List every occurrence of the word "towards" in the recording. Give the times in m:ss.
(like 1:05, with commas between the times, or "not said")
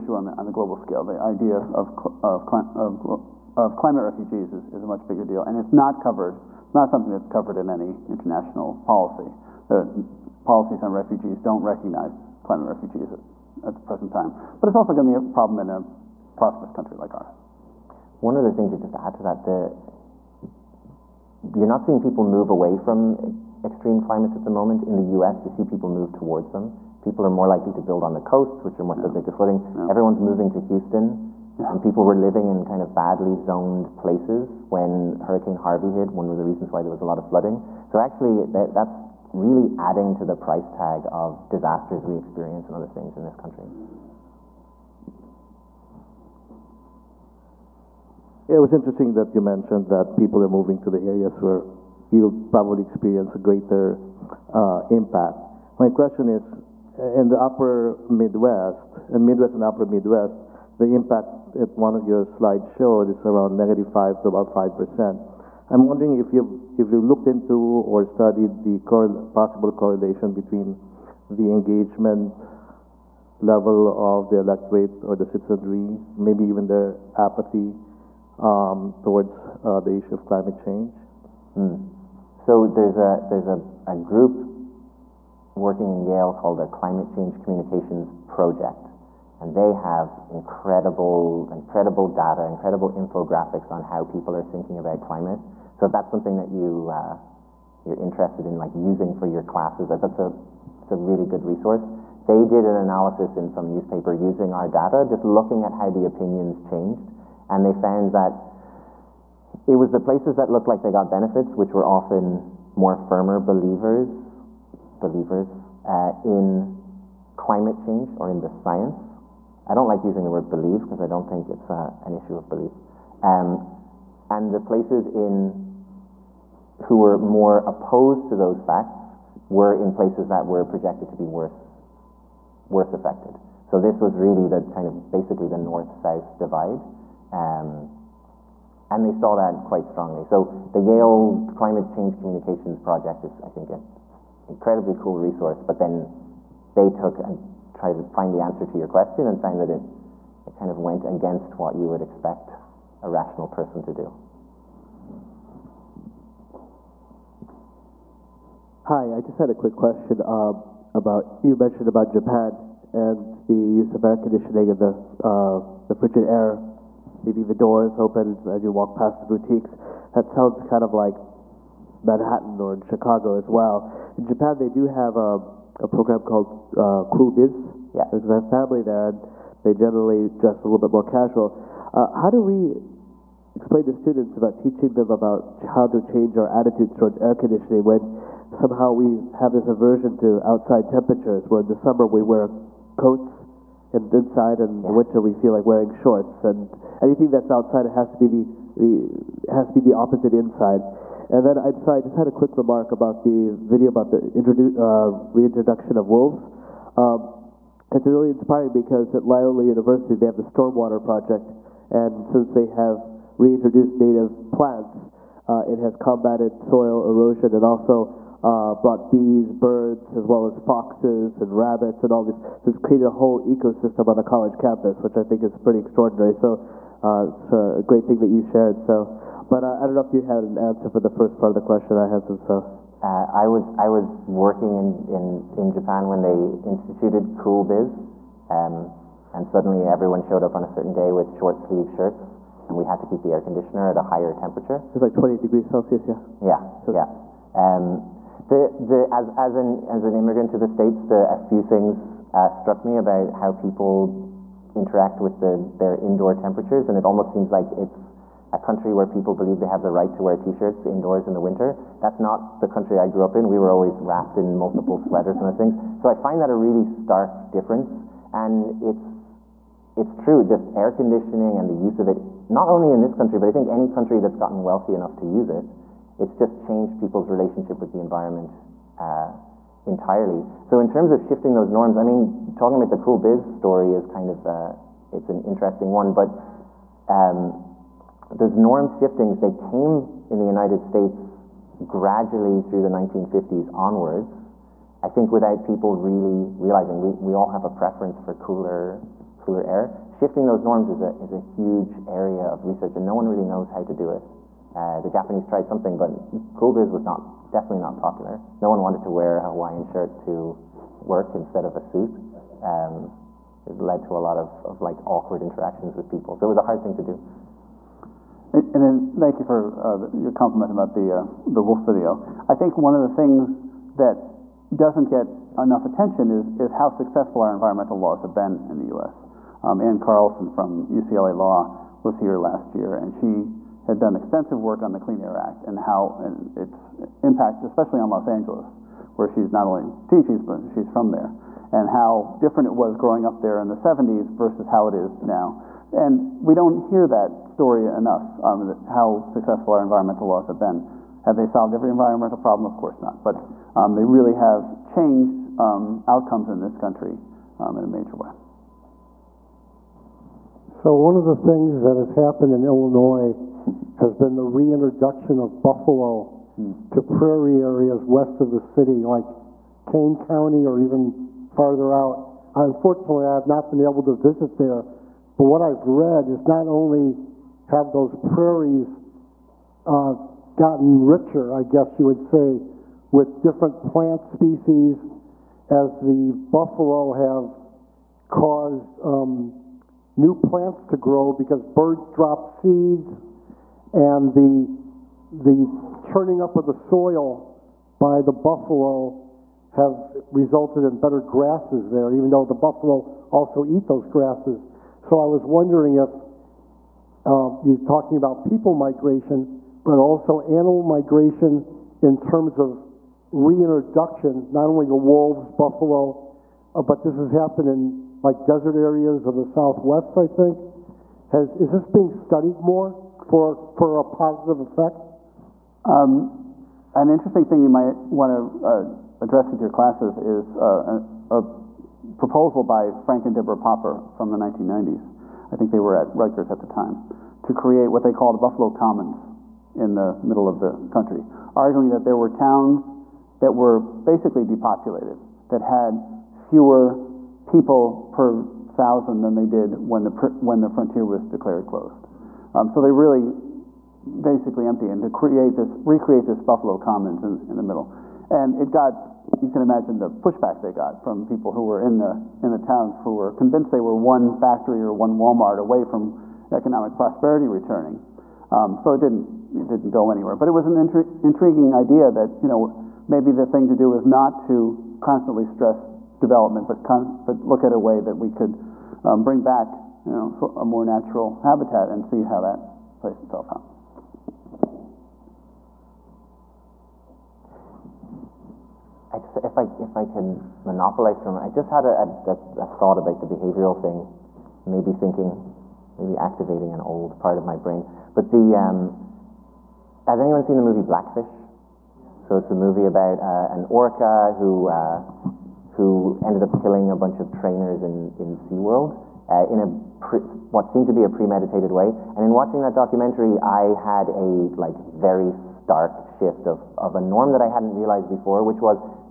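0:26, 1:19, 3:06.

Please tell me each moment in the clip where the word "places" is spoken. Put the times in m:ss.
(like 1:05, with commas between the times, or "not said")
0:33, 1:50, 2:04, 2:09.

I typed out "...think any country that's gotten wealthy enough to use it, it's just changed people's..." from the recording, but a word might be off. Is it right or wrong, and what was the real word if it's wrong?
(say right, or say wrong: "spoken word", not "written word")
right.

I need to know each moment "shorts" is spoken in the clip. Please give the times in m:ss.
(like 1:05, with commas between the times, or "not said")
3:15, 4:01.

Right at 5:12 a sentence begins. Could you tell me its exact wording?
Um, it led to a lot of, of like awkward interactions with people.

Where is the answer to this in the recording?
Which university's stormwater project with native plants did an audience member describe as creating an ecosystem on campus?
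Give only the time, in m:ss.
3:29.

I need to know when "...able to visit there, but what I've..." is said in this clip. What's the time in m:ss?
6:13.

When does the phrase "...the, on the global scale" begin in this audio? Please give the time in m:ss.
0:00.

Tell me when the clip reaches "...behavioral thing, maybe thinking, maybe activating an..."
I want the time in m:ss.
8:13.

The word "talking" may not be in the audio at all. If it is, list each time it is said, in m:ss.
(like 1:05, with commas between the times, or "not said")
4:42, 6:47.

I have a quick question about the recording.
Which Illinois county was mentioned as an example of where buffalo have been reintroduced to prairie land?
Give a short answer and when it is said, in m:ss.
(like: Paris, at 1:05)
Kane County, at 6:09.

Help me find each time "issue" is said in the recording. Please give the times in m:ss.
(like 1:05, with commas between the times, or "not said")
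1:19, 2:02.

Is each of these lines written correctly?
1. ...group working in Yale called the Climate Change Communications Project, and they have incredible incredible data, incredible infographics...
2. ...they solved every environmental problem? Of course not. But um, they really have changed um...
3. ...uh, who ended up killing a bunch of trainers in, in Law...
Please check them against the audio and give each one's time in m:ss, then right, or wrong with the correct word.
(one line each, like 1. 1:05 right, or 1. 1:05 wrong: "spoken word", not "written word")
1. 1:23 right
2. 5:51 right
3. 8:24 wrong: "SeaWorld", not "Law".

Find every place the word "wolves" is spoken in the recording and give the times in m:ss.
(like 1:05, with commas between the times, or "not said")
3:26, 6:54.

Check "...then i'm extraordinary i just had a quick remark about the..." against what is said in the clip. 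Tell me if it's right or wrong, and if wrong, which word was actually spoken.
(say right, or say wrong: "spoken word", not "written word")
wrong: "sorry", not "extraordinary".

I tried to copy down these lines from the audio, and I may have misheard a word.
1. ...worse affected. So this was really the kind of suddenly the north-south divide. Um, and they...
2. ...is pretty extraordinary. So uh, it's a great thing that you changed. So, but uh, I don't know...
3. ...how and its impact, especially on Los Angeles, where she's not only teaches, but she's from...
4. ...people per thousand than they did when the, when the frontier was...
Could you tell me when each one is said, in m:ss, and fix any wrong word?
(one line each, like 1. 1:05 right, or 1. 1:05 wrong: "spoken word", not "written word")
1. 2:12 wrong: "basically", not "suddenly"
2. 3:45 wrong: "shared", not "changed"
3. 5:35 right
4. 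7:27 right.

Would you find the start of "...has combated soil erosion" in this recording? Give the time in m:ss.
3:35.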